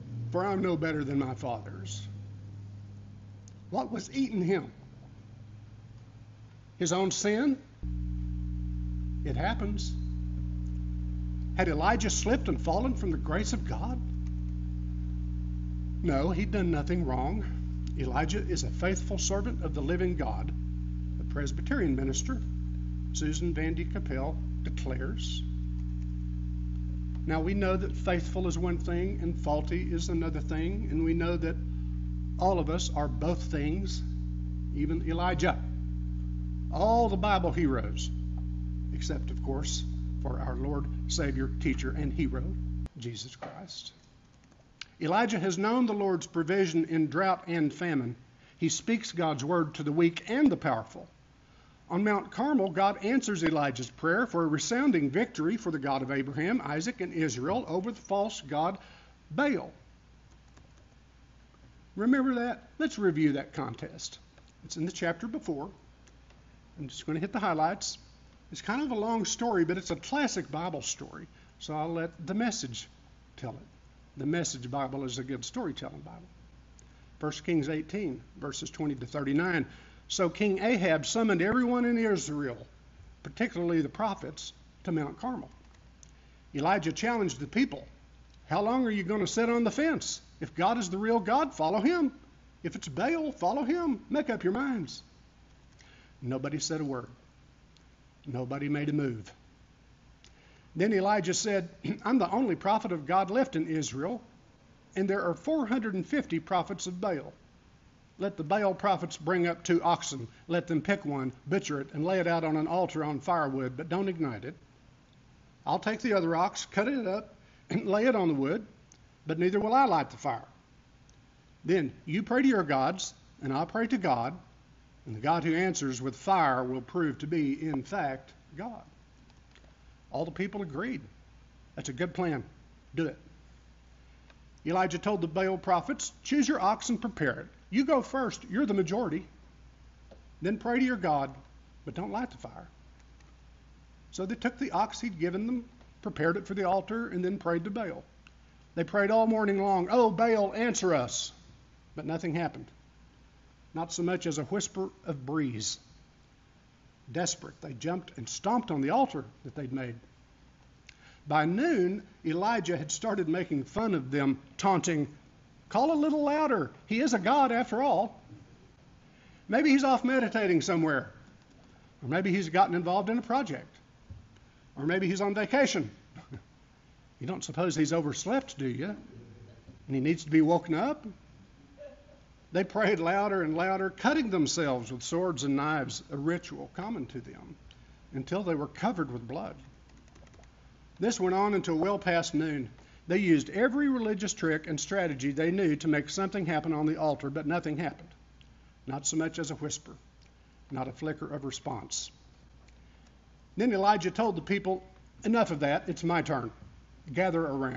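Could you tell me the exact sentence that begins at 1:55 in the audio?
I'll take the other ox, cut it up, and lay it on the wood, but neither will I light the fire.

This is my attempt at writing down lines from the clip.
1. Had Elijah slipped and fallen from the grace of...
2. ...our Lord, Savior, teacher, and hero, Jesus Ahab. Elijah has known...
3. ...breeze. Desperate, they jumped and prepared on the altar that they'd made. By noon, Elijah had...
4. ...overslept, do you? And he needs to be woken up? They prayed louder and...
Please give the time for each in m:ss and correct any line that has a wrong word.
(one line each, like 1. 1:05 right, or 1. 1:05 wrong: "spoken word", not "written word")
1. 0:11 right
2. 0:40 wrong: "Christ", not "Ahab"
3. 2:35 wrong: "stomped", not "prepared"
4. 2:57 right.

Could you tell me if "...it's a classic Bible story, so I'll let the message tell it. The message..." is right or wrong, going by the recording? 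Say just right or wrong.
right.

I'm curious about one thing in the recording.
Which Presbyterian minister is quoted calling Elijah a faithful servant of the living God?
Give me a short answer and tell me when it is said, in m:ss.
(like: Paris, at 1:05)
Susan Vande Kappelle, at 0:23.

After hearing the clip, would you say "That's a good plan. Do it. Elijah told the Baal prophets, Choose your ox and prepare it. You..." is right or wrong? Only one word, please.
right.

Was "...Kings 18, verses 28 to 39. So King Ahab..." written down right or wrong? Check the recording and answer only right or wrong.
wrong.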